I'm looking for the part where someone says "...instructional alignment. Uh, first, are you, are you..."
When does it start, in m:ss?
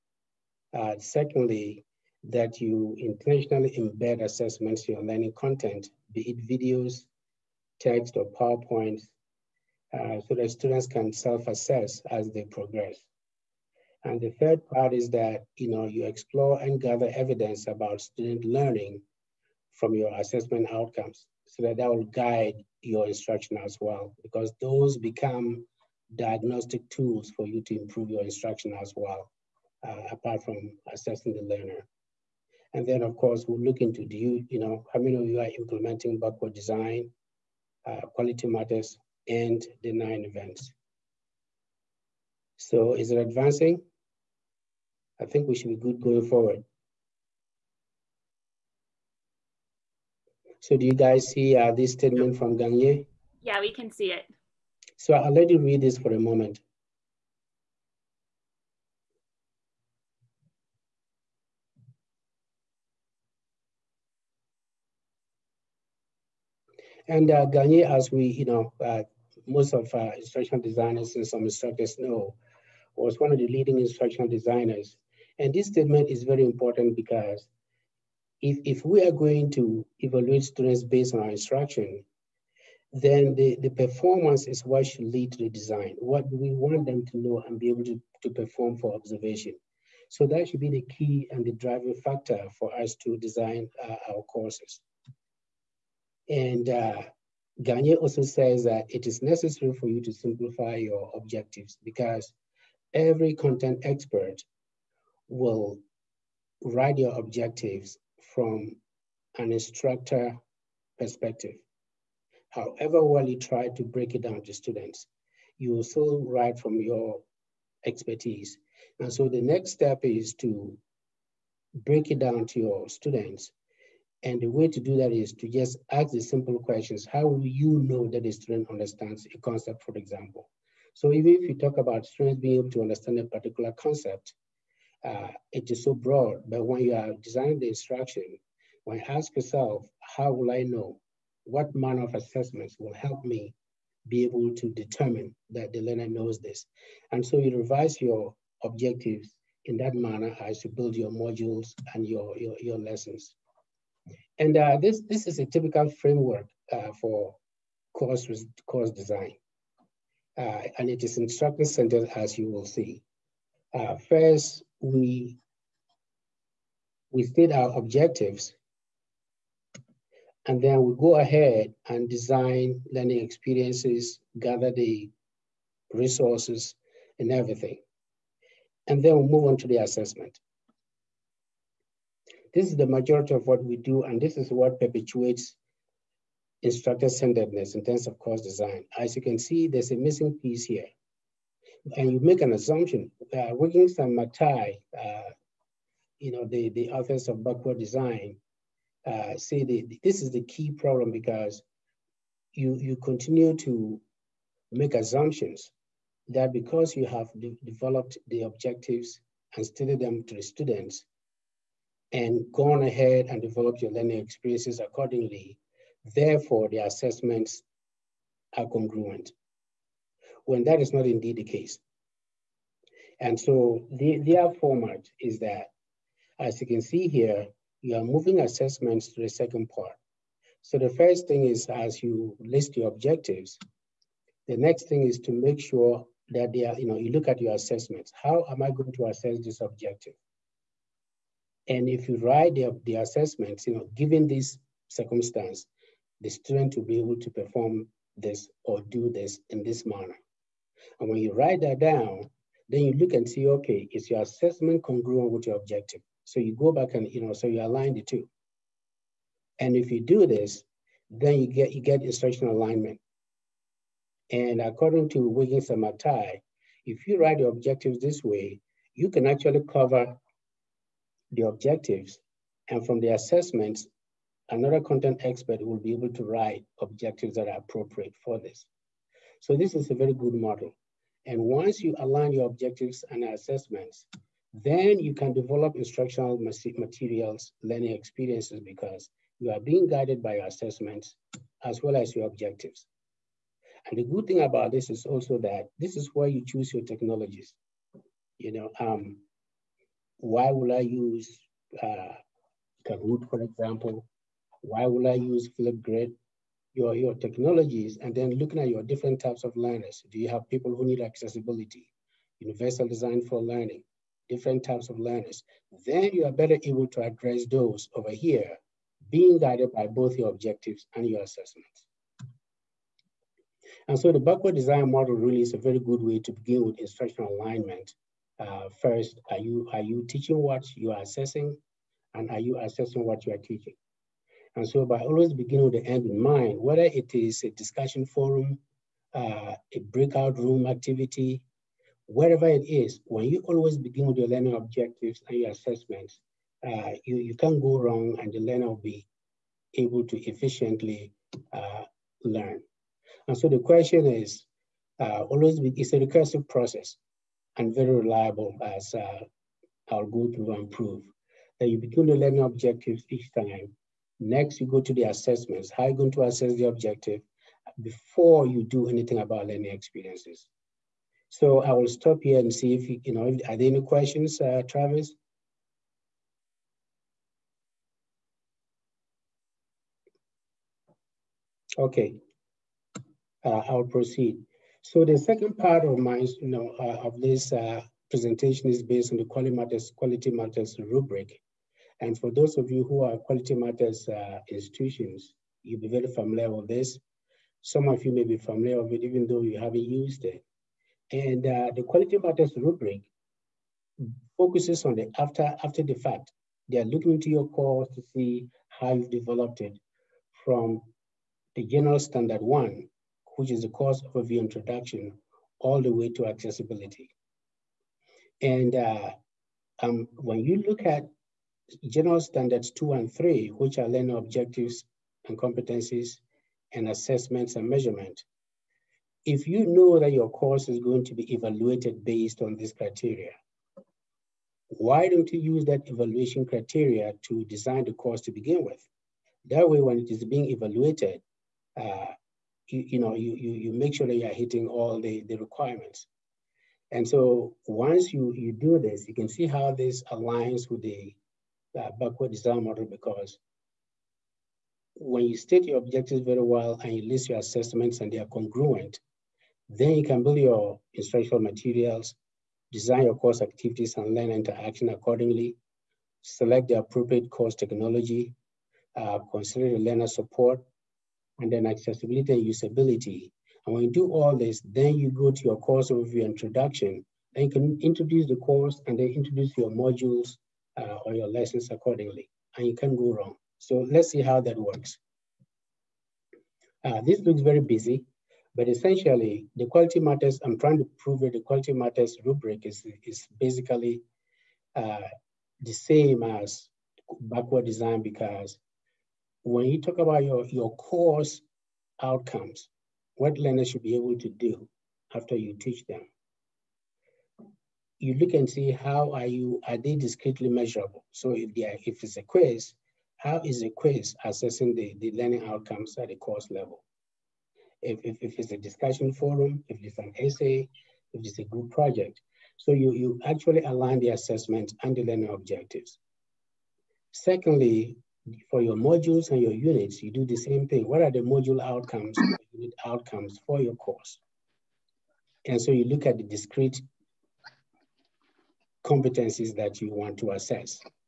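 5:26.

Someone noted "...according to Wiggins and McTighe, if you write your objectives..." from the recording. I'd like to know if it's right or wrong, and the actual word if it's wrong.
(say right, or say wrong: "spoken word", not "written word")
right.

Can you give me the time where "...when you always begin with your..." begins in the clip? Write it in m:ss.
5:43.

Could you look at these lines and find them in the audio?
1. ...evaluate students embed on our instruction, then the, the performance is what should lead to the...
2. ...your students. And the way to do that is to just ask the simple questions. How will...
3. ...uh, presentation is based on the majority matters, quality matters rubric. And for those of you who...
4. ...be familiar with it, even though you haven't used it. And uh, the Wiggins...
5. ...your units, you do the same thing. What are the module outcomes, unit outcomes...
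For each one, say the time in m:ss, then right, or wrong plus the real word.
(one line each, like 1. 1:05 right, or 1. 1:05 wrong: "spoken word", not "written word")
1. 1:19 wrong: "based", not "embed"
2. 2:02 right
3. 6:27 wrong: "quality", not "majority"
4. 6:38 wrong: "Quality", not "Wiggins"
5. 8:49 right.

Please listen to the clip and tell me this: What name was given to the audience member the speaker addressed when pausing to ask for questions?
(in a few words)
Travis.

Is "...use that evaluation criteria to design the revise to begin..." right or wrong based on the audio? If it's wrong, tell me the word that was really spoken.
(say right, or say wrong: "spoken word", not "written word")
wrong: "course", not "revise".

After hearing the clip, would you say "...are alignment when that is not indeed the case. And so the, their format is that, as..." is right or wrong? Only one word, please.
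wrong.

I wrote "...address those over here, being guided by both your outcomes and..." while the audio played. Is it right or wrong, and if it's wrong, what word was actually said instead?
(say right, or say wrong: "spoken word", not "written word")
wrong: "objectives", not "outcomes".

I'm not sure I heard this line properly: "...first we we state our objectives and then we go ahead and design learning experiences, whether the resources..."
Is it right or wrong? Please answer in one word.
wrong.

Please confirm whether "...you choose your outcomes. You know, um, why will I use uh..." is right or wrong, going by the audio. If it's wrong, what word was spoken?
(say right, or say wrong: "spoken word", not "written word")
wrong: "technologies", not "outcomes".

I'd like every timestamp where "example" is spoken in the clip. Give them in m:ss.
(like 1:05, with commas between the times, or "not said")
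2:09, 5:03.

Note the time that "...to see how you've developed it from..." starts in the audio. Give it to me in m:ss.
6:47.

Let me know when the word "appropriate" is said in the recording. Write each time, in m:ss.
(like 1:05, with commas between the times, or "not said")
4:37, 7:46.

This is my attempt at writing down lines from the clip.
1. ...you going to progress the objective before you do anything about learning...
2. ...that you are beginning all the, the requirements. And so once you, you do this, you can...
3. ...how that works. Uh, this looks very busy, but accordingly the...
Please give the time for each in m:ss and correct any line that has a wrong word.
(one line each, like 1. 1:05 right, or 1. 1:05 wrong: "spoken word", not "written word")
1. 6:05 wrong: "assess", not "progress"
2. 7:24 wrong: "hitting", not "beginning"
3. 8:04 wrong: "essentially", not "accordingly".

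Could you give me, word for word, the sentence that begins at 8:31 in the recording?
So if they are, if it's a quiz, how is a quiz assessing the, the learning outcomes at the course level?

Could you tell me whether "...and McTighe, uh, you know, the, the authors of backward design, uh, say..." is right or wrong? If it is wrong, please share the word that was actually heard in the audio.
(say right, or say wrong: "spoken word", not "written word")
right.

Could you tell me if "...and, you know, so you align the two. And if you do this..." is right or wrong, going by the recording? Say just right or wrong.
right.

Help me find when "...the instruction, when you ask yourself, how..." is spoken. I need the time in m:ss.
2:17.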